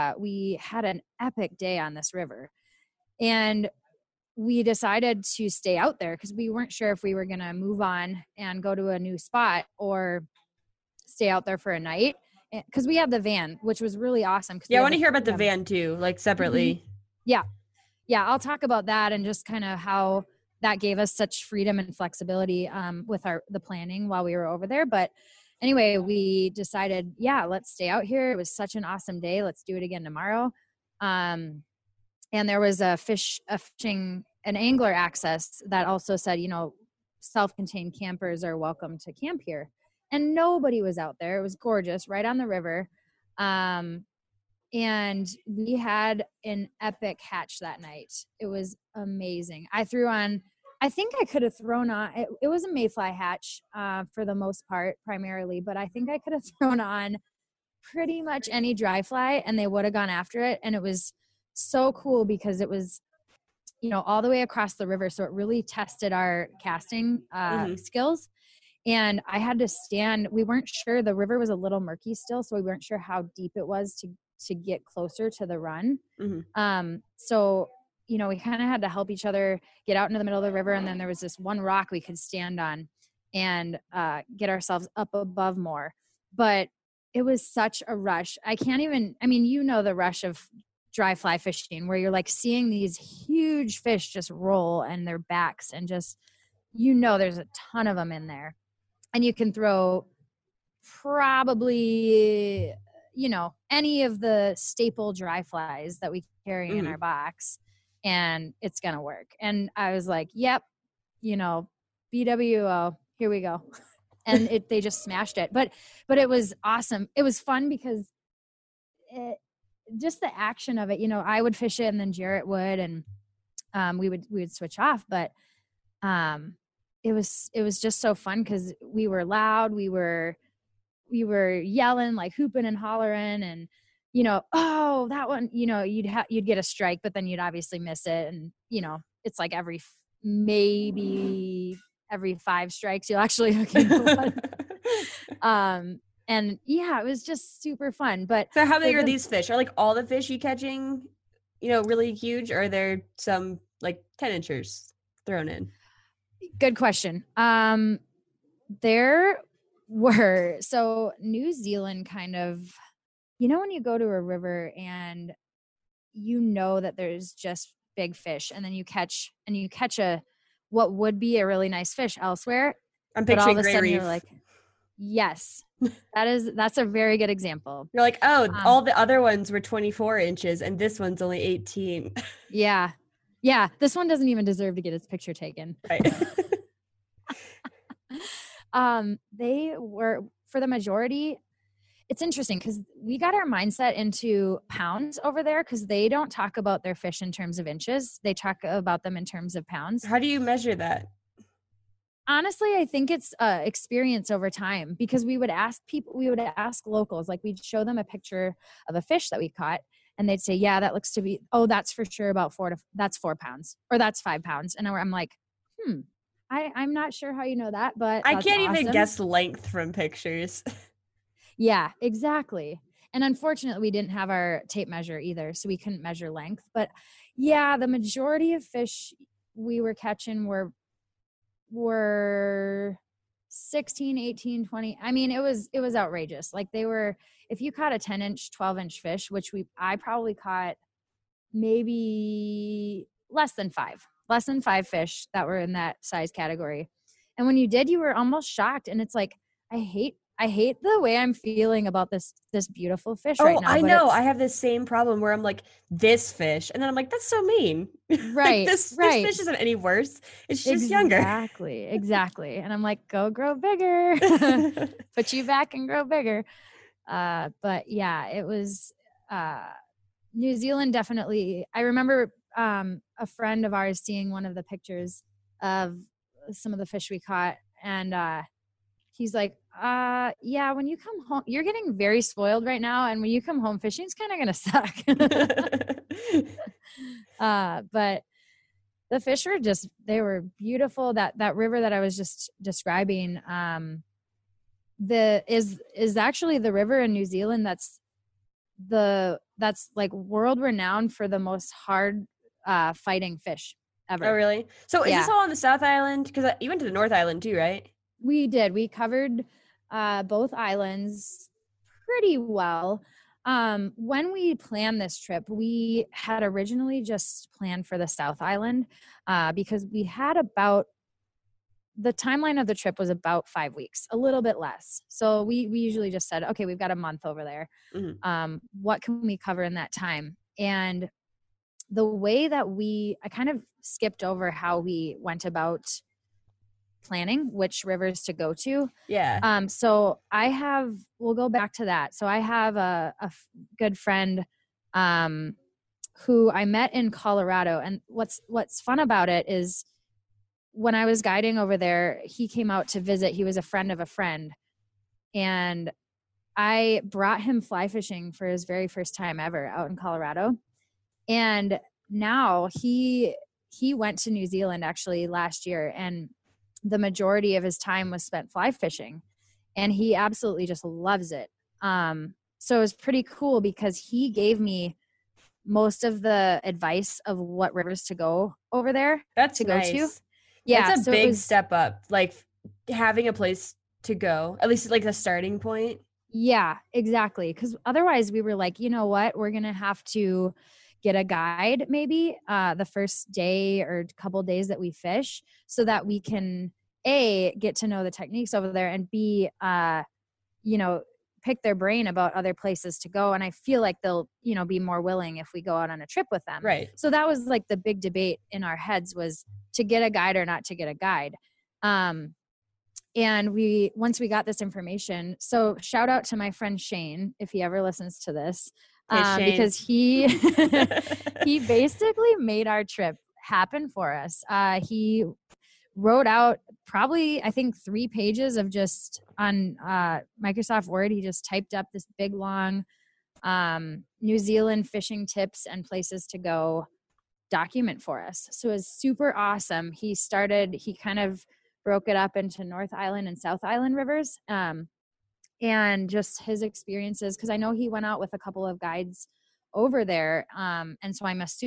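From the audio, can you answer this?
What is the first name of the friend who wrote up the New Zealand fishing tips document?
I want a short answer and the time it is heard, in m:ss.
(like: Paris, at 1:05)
Shane, at 6:56.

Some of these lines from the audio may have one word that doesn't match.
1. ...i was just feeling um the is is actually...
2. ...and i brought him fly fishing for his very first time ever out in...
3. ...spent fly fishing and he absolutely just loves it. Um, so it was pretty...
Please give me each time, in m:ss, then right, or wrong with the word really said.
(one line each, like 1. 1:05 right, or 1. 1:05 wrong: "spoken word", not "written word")
1. 4:51 wrong: "describing", not "feeling"
2. 5:55 right
3. 6:08 right.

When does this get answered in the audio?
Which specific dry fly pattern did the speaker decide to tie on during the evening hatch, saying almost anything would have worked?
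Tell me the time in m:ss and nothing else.
1:52.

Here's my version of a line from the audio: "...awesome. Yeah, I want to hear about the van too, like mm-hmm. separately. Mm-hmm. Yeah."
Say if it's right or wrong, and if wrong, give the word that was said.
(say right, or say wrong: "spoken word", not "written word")
right.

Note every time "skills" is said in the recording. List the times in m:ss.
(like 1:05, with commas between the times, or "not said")
1:07.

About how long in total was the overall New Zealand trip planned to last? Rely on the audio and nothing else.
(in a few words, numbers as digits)
about 5 weeks.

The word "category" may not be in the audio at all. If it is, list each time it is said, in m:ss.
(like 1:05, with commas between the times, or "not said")
4:06.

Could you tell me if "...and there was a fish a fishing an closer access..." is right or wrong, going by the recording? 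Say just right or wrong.
wrong.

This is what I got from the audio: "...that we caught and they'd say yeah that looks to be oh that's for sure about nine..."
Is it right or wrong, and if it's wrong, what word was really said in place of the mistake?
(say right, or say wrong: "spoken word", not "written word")
wrong: "four", not "nine".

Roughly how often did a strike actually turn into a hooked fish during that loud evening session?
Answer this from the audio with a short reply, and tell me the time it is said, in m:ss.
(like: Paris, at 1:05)
every 5 strikes, at 2:22.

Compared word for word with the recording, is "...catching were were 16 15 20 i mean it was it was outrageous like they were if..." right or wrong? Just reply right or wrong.
wrong.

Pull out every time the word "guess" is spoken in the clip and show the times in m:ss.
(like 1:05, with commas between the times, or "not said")
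3:38.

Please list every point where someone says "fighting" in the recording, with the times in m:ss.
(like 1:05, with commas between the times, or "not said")
5:02.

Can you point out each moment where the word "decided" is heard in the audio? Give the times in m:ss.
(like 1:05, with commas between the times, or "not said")
0:04, 0:26.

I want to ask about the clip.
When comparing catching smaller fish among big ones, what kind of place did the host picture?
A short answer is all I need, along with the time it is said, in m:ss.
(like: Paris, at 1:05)
reef, at 2:53.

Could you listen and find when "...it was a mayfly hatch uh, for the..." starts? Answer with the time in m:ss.
0:52.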